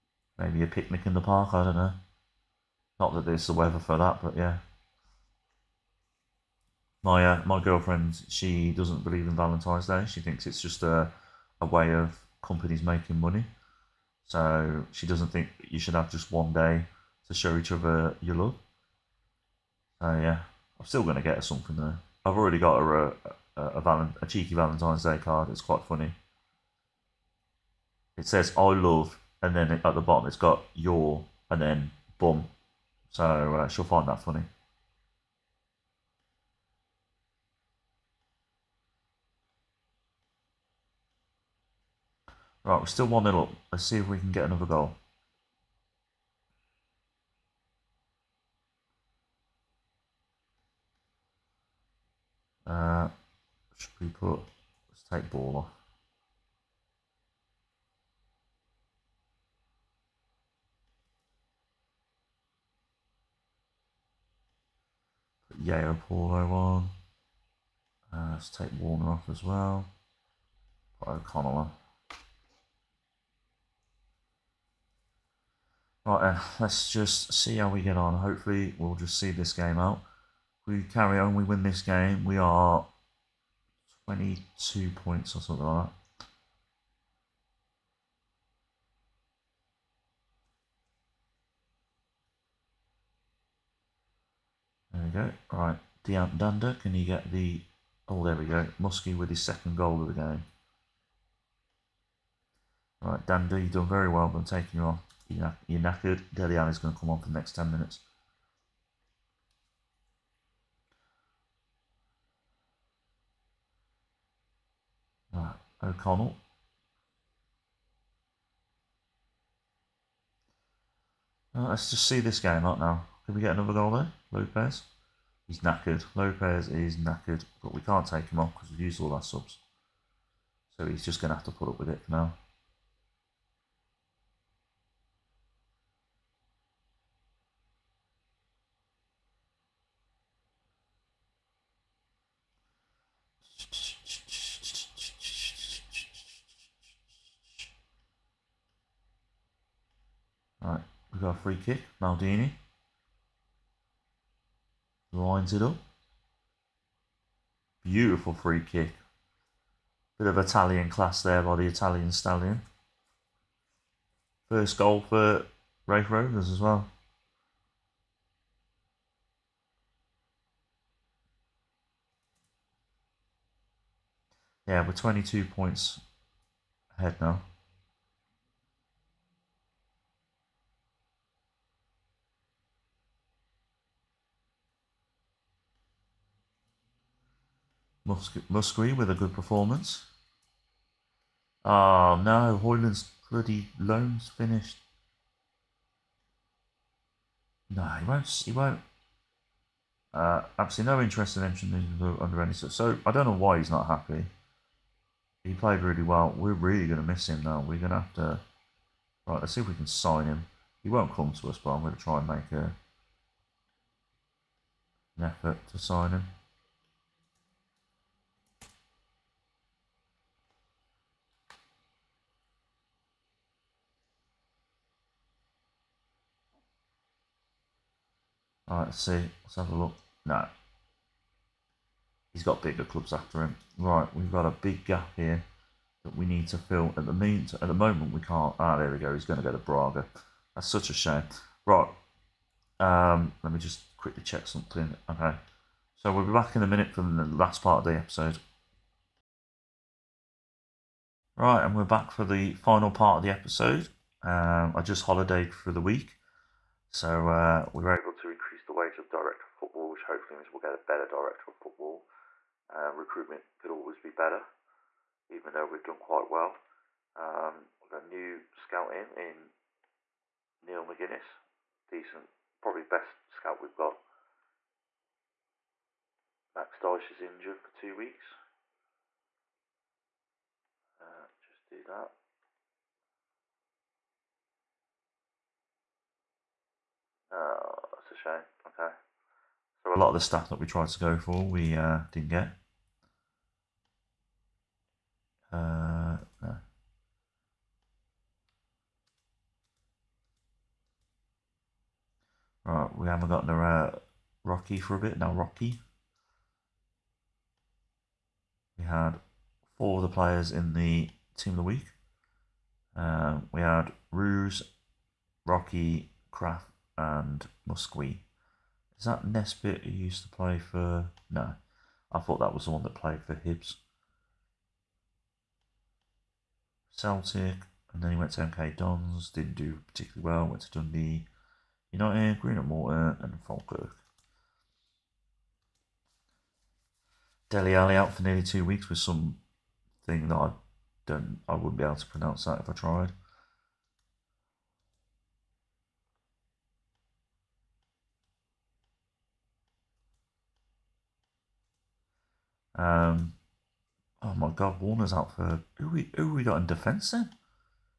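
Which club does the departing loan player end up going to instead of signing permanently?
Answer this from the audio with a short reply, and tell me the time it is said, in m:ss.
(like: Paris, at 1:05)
Braga, at 3:59.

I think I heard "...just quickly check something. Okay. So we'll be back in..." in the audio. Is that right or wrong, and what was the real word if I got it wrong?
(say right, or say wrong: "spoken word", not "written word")
right.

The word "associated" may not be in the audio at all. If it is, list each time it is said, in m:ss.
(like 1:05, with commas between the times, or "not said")
not said.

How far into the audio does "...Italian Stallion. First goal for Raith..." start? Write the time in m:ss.
2:41.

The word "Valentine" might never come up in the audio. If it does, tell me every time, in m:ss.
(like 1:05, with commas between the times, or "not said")
0:09, 0:24.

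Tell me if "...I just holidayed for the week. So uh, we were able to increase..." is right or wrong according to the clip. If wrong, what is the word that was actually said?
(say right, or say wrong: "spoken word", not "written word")
right.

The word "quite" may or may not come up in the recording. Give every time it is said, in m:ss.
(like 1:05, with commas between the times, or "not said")
0:25, 4:25.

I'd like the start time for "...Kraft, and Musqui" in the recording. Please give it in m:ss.
5:16.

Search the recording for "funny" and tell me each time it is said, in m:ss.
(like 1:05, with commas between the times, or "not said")
0:25, 0:34.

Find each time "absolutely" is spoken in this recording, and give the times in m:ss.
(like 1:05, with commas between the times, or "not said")
3:20.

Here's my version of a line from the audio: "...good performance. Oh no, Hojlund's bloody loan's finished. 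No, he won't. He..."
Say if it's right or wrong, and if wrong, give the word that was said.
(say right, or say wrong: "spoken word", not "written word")
right.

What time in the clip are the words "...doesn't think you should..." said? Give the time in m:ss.
0:15.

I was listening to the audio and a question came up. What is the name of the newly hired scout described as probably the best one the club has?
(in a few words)
Neil McGuinness.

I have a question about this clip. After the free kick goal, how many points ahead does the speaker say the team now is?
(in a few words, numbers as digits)
22.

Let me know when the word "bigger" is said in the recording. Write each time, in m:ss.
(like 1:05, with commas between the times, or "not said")
3:52.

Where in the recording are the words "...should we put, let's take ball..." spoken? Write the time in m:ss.
0:53.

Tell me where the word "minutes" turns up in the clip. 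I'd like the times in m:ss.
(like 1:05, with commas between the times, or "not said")
1:47, 4:06.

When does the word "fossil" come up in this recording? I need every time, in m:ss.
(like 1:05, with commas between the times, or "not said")
not said.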